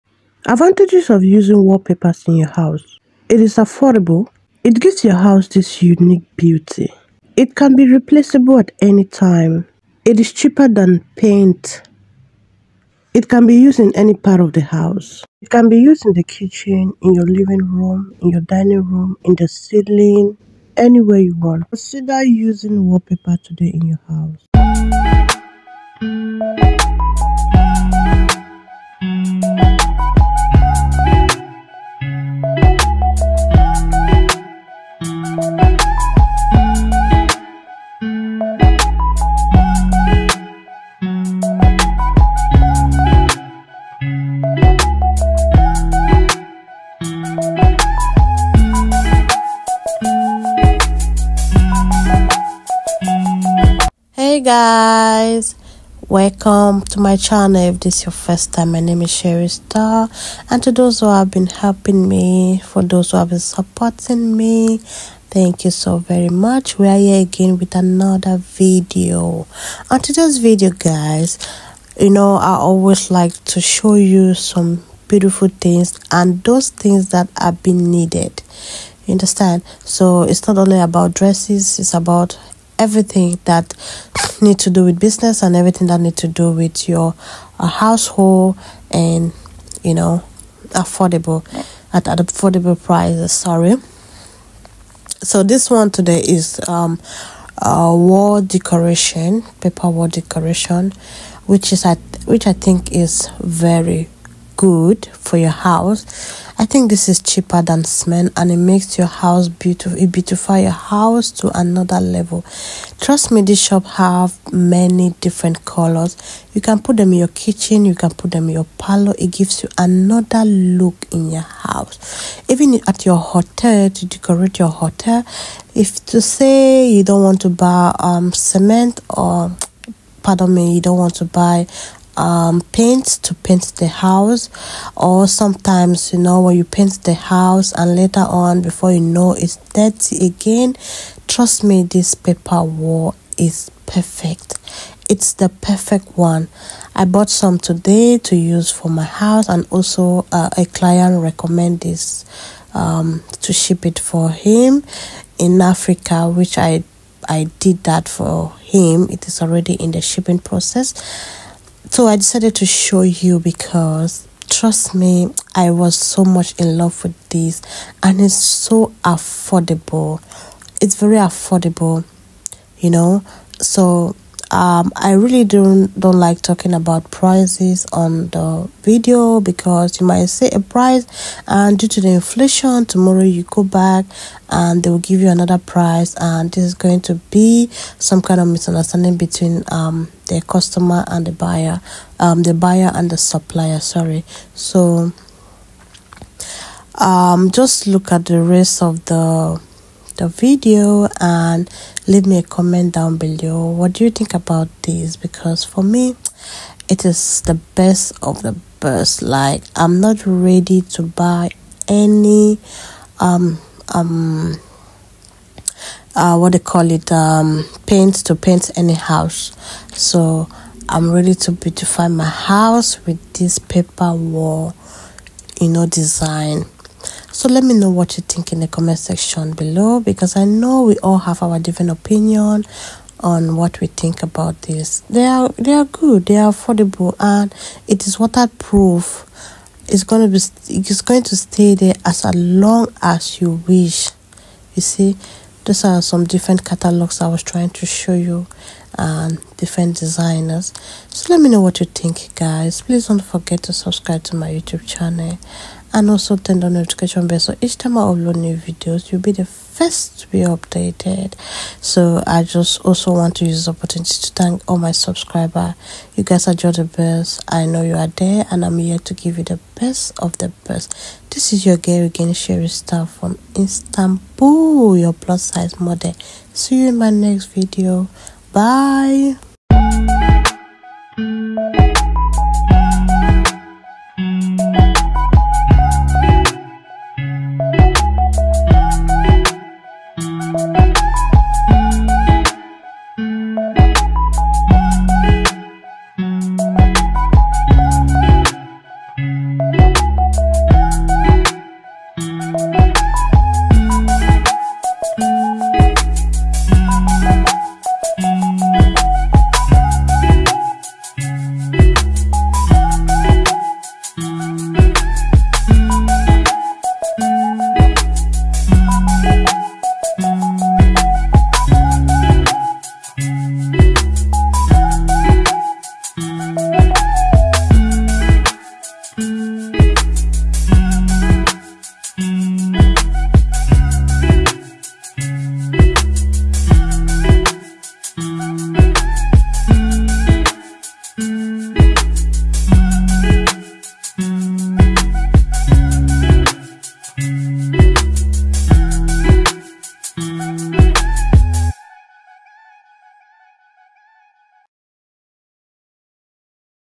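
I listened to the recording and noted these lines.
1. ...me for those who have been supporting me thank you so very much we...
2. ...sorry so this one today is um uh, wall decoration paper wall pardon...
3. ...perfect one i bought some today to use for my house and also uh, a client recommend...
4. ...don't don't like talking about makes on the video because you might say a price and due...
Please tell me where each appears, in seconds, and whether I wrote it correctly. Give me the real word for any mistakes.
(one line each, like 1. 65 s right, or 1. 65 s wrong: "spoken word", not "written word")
1. 62 s right
2. 93 s wrong: "decoration", not "pardon"
3. 145 s right
4. 175 s wrong: "prices", not "makes".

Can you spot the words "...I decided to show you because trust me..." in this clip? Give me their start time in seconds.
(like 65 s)
162 s.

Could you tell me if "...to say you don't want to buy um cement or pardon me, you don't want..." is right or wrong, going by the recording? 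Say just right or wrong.
right.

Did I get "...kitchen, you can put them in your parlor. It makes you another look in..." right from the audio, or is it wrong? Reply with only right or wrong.
wrong.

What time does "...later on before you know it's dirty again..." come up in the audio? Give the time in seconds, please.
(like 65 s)
137 s.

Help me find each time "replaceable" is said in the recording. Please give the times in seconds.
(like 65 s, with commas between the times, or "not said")
7 s.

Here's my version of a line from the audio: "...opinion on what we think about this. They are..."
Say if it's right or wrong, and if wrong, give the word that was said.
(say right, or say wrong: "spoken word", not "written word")
right.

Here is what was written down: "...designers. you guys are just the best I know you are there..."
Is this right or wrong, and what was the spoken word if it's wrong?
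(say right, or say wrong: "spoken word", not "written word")
wrong: "subscribers", not "designers".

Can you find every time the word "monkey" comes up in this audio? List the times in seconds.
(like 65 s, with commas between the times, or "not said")
not said.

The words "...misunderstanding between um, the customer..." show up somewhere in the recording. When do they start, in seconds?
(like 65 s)
188 s.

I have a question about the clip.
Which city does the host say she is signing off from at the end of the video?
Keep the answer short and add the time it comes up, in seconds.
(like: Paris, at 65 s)
Istanbul, at 273 s.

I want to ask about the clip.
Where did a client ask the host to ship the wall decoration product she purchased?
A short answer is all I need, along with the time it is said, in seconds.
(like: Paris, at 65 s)
Africa, at 155 s.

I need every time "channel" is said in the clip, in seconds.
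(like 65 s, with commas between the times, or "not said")
57 s, 254 s.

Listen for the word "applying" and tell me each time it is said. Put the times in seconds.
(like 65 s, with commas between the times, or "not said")
not said.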